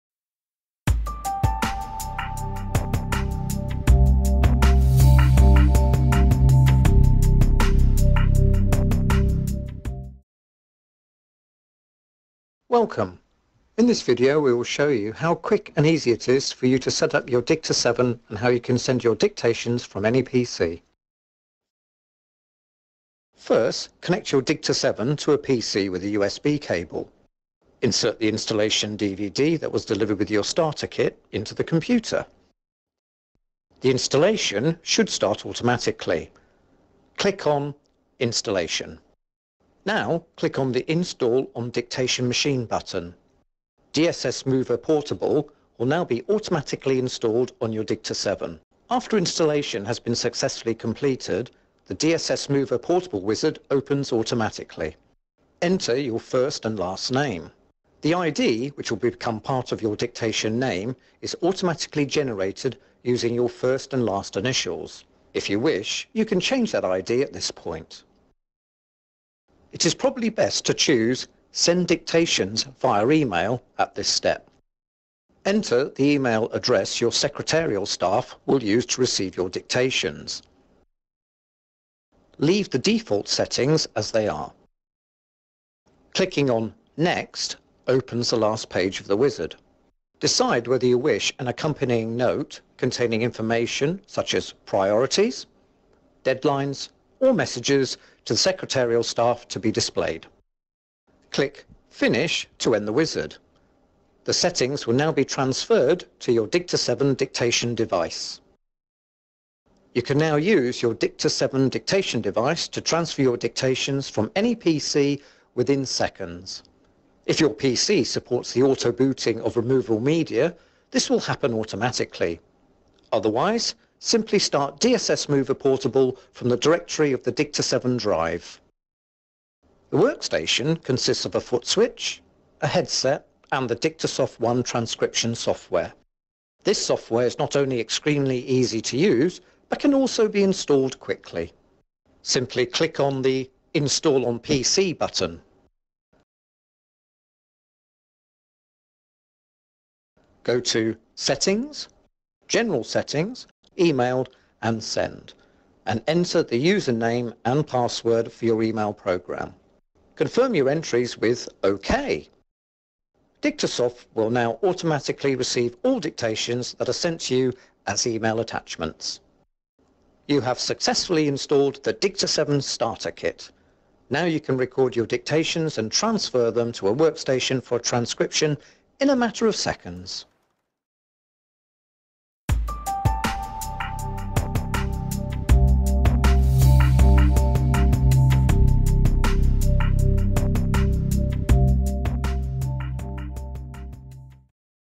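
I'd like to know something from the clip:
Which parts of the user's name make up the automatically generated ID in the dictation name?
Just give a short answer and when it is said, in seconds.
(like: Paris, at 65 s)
First and last initials, at 63 s.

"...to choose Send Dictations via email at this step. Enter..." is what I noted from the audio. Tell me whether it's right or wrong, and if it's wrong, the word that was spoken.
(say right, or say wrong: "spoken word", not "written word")
right.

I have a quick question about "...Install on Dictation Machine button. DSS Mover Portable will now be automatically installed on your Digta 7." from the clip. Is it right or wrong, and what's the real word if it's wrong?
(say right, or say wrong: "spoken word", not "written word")
right.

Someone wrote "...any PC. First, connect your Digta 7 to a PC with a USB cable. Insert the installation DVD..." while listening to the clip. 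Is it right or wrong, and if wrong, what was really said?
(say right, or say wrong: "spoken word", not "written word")
right.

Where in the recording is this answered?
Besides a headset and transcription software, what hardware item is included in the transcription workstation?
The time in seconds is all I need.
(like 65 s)
131 s.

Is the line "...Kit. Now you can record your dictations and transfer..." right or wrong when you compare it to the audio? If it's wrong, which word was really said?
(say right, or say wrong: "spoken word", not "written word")
right.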